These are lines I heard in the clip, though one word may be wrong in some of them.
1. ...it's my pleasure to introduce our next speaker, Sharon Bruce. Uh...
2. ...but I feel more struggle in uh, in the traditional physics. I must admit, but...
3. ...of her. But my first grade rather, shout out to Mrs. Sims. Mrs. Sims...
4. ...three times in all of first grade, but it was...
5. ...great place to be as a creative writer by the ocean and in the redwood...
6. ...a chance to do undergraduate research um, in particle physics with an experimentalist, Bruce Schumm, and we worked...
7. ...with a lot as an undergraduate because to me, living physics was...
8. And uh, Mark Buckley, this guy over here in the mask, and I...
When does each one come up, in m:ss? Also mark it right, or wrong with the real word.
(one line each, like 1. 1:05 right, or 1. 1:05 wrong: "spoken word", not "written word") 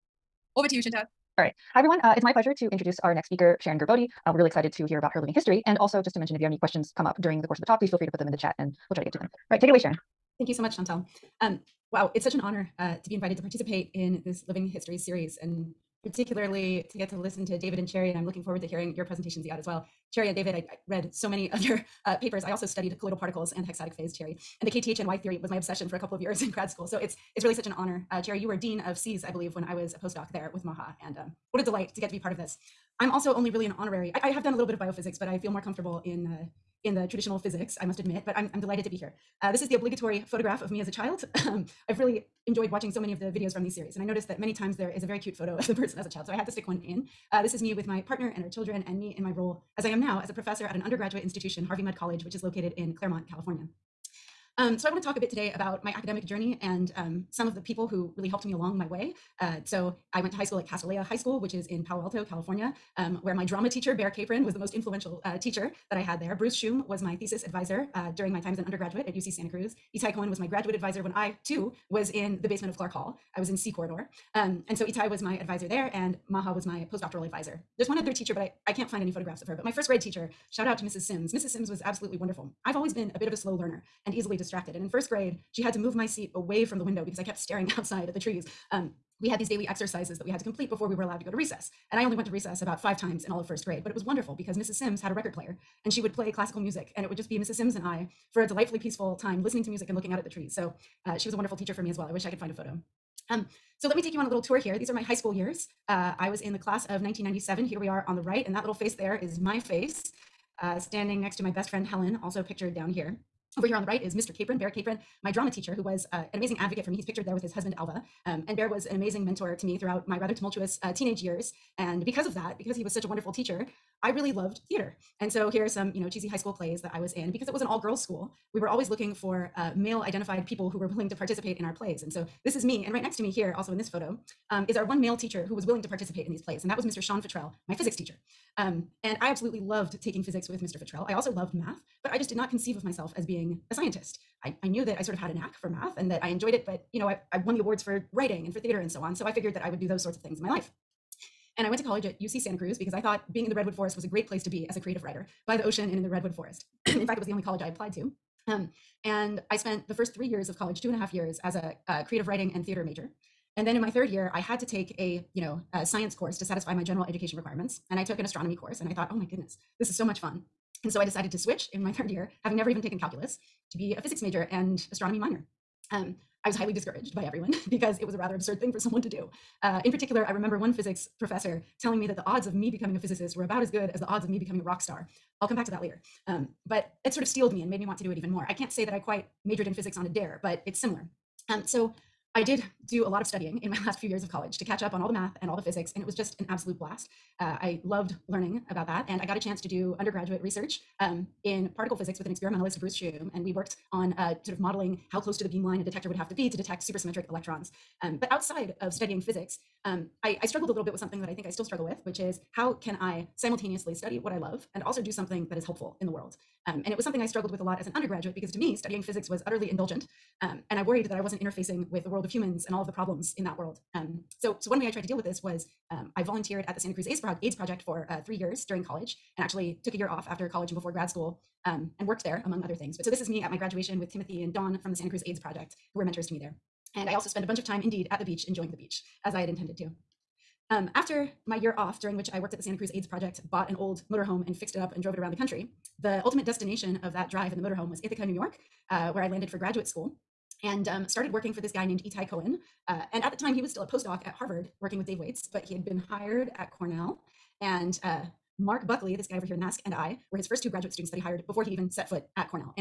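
1. 0:02 wrong: "Gerbode", not "Bruce"
2. 0:35 wrong: "comfortable", not "struggle"
3. 1:19 wrong: "teacher", not "rather"
4. 1:32 wrong: "five", not "three"
5. 2:34 right
6. 3:19 right
7. 3:37 wrong: "studying", not "living"
8. 4:17 right.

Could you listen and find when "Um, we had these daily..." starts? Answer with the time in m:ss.
1:28.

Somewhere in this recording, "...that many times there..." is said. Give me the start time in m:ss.
0:44.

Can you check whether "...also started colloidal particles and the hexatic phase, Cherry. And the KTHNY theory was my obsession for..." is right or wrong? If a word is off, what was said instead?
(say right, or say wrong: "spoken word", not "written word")
wrong: "studied", not "started".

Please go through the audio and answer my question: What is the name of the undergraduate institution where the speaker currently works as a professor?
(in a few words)
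Harvey Mudd College.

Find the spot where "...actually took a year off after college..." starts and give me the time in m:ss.
3:49.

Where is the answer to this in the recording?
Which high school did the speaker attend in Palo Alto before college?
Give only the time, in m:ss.
1:00.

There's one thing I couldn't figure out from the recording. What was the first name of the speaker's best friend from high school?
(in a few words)
Helen.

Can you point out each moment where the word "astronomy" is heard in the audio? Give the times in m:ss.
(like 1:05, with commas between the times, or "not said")
2:48, 2:54.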